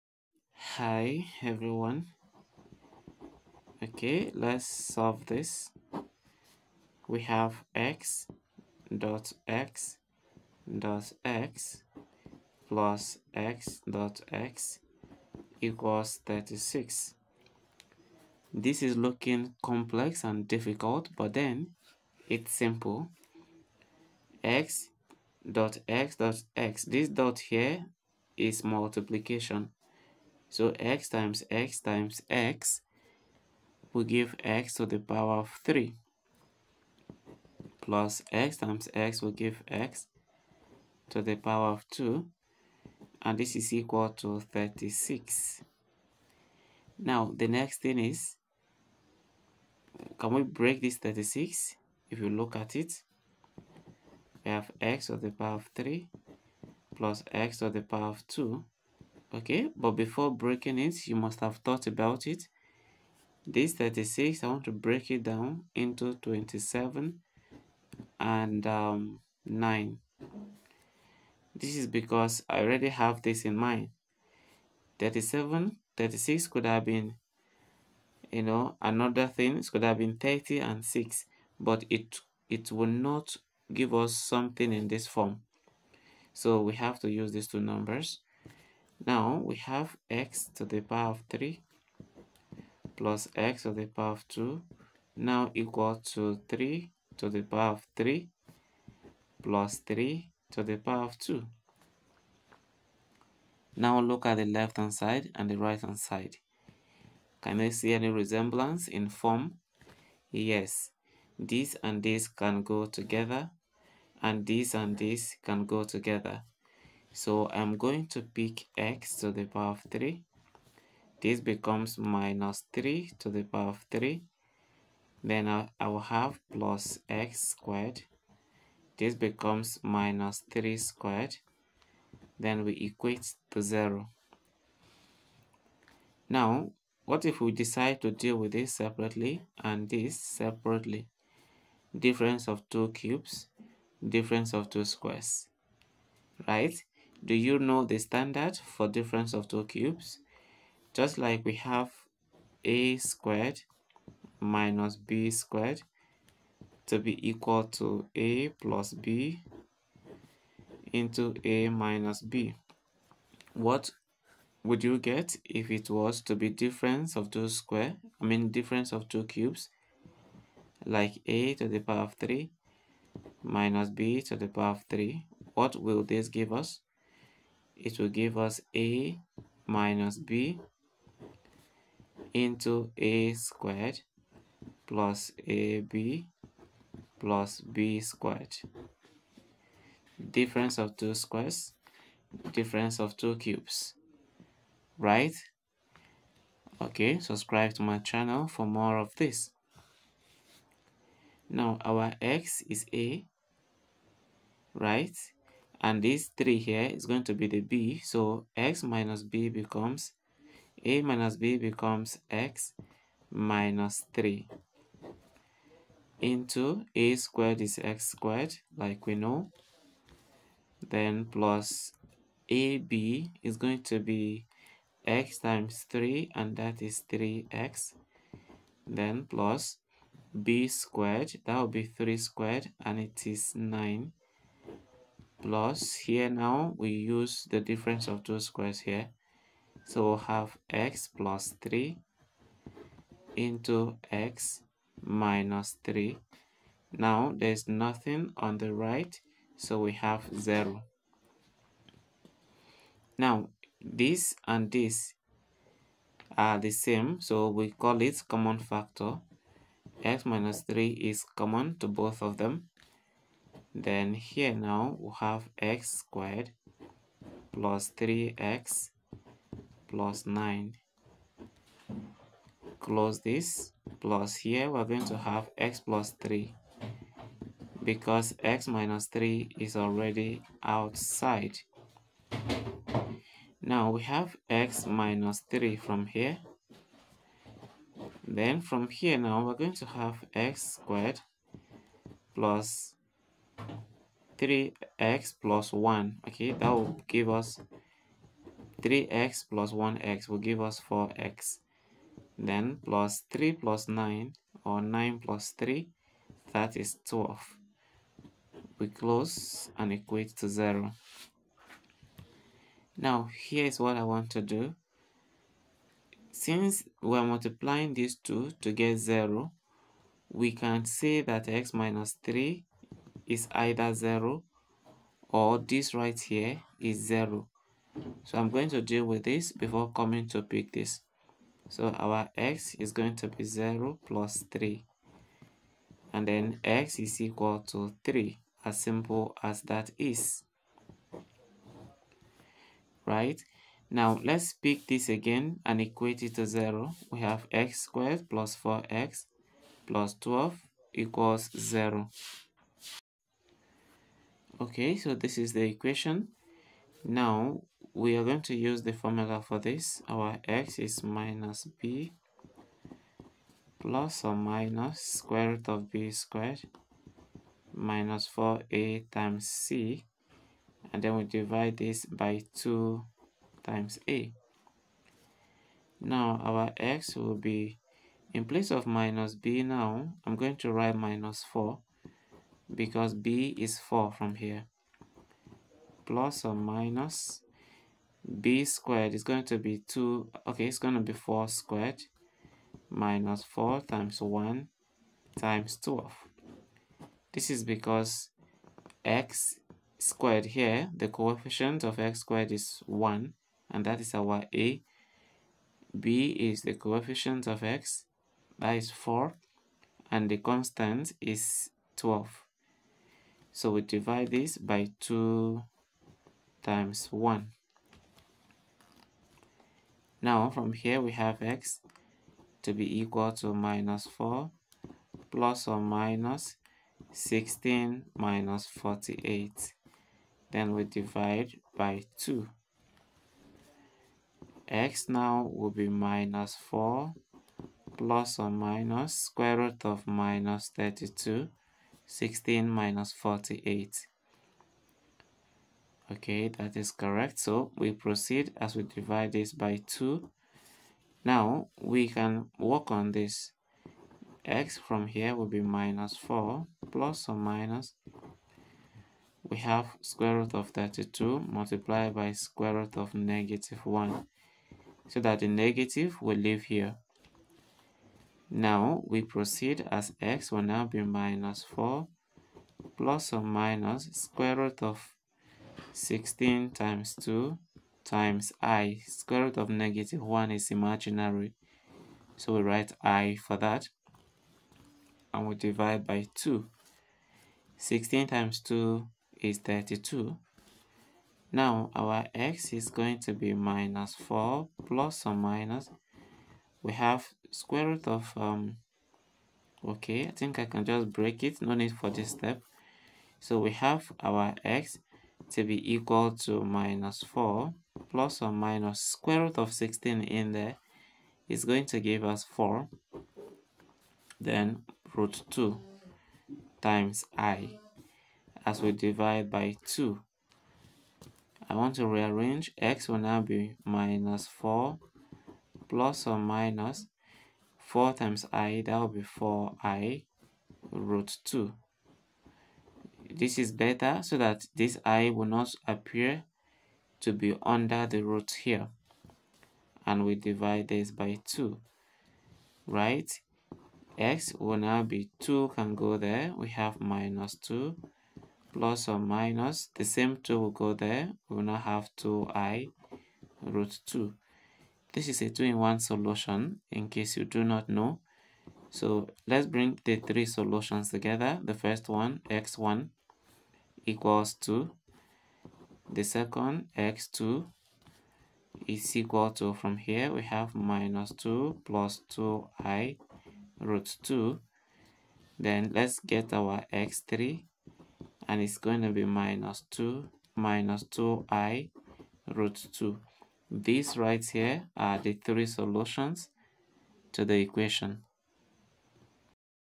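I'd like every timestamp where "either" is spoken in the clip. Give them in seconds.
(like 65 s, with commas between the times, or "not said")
323 s.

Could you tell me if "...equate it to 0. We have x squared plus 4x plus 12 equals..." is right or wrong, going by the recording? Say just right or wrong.
right.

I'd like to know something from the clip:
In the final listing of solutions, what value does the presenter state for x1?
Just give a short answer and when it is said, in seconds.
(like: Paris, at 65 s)
2, at 562 s.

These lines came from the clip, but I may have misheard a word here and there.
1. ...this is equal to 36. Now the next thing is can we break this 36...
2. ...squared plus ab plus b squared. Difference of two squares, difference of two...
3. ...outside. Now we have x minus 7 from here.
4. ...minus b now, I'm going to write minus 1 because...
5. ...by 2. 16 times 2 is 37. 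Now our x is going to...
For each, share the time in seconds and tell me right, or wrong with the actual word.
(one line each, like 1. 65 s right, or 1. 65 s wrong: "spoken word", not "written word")
1. 43 s right
2. 183 s right
3. 280 s wrong: "3", not "7"
4. 378 s wrong: "4", not "1"
5. 486 s wrong: "32", not "37".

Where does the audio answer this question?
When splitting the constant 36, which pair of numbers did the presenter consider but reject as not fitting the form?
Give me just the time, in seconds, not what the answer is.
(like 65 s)
80 s.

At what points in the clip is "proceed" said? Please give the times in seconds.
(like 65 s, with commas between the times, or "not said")
447 s, 469 s.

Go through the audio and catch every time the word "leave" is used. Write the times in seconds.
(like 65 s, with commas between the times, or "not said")
466 s.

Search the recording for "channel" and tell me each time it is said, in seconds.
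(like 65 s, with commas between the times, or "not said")
197 s.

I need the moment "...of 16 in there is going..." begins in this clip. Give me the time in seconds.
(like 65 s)
509 s.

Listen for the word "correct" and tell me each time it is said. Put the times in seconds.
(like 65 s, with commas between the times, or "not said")
446 s.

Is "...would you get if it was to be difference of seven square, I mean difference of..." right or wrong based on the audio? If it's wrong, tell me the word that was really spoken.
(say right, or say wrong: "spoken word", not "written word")
wrong: "two", not "seven".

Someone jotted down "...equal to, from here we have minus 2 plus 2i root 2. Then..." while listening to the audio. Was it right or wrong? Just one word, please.
right.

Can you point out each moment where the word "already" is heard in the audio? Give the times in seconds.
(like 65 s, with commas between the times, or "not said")
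72 s, 279 s.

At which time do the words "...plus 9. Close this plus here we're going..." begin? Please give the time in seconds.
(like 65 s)
269 s.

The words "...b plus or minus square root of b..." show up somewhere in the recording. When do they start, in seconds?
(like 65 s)
361 s.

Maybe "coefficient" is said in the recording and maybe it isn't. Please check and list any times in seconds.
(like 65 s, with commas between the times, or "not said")
401 s, 406 s.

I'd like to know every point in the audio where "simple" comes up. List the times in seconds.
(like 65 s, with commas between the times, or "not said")
22 s, 338 s.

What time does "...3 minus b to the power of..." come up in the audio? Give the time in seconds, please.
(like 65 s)
172 s.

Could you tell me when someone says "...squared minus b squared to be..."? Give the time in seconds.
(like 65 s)
152 s.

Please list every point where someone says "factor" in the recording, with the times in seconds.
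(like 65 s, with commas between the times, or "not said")
258 s.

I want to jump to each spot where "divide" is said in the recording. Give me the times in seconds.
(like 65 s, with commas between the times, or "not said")
371 s, 413 s, 430 s, 448 s, 485 s, 518 s, 540 s.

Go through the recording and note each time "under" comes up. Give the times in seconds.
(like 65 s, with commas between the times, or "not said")
537 s.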